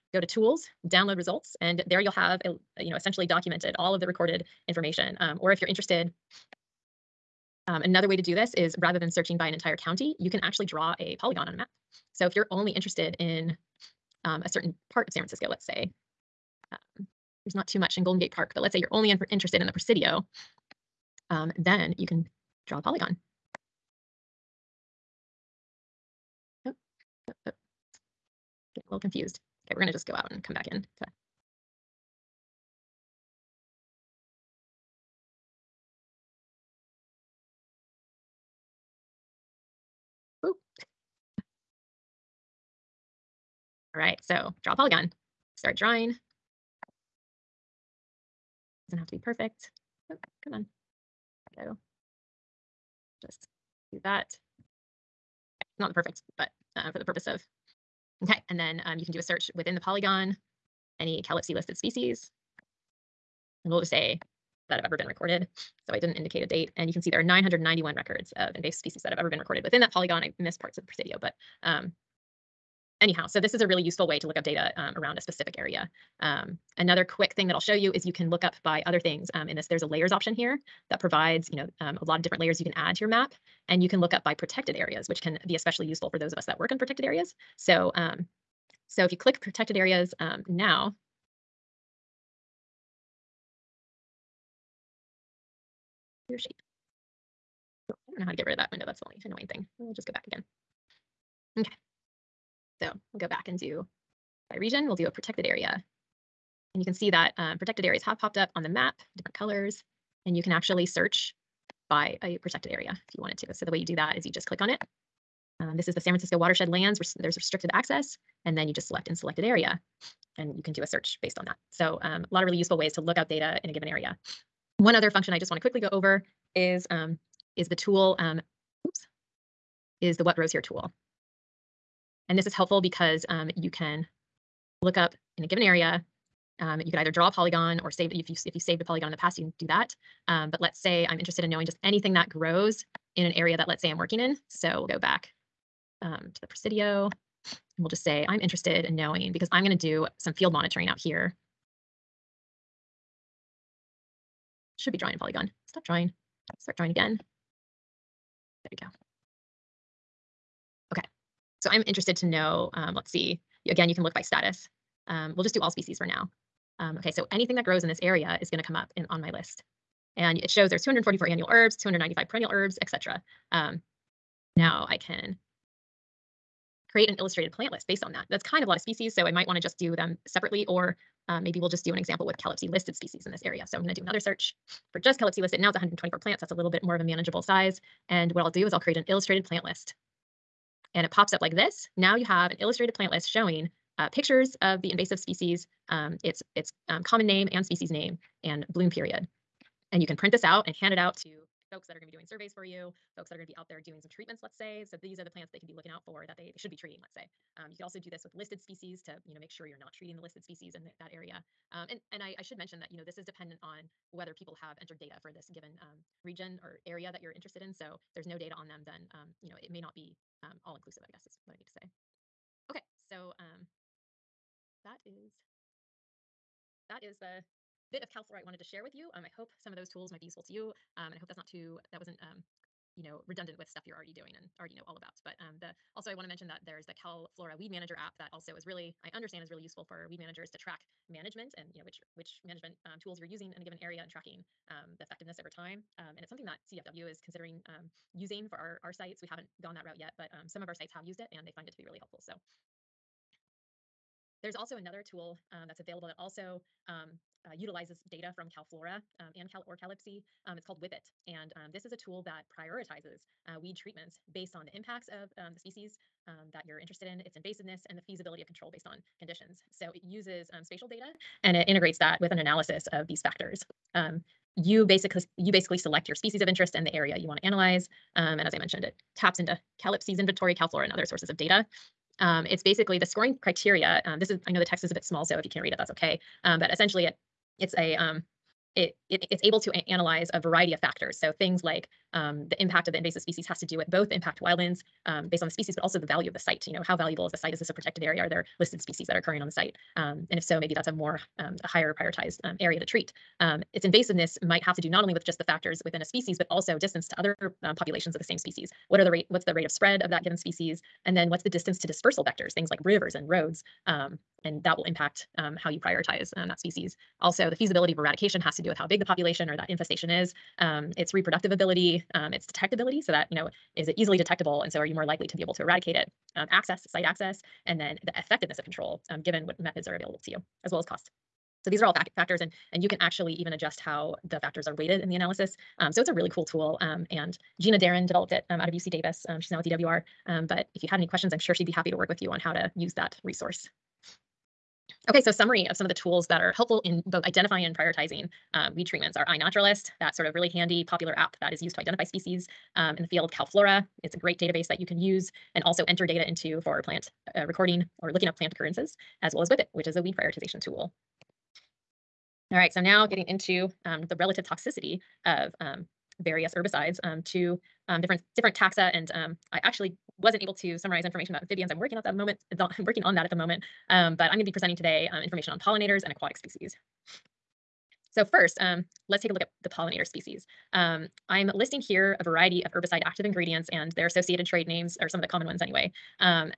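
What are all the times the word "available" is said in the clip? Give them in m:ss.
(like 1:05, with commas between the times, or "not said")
4:15, 5:29.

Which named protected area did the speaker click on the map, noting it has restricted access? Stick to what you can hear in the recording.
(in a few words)
San Francisco watershed lands.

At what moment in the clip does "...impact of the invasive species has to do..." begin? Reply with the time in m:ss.
4:52.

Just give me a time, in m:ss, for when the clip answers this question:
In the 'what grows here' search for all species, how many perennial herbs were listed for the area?
2:51.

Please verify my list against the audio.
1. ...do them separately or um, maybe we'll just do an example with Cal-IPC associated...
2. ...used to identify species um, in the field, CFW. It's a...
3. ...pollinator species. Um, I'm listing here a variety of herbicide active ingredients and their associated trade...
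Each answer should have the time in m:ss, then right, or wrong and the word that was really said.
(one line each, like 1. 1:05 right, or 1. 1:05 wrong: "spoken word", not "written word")
1. 2:59 wrong: "listed", not "associated"
2. 5:51 wrong: "CalFlora", not "CFW"
3. 6:19 right.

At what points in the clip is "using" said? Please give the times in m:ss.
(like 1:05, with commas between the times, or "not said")
4:03, 4:08.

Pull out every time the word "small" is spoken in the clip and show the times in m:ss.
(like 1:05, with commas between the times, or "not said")
4:45.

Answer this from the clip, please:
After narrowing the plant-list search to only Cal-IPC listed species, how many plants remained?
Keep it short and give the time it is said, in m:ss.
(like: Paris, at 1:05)
124, at 3:05.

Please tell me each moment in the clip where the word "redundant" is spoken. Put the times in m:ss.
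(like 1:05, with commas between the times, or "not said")
3:53.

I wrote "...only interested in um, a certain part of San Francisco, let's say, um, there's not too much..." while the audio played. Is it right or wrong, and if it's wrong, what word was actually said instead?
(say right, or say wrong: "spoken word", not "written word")
right.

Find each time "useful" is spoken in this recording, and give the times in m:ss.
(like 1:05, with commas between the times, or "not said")
1:13, 1:25, 2:02, 3:50, 3:59.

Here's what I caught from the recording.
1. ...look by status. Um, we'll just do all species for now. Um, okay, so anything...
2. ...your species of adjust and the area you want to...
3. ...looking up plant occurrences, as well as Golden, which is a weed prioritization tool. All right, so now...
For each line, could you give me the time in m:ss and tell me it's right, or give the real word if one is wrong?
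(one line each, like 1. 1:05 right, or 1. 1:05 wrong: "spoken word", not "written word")
1. 2:44 right
2. 4:36 wrong: "interest", not "adjust"
3. 5:58 wrong: "Whippet", not "Golden".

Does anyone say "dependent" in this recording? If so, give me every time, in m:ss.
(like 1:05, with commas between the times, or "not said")
3:33.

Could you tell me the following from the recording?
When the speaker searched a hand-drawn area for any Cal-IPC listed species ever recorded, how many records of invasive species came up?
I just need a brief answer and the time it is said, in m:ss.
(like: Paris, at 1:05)
991, at 1:07.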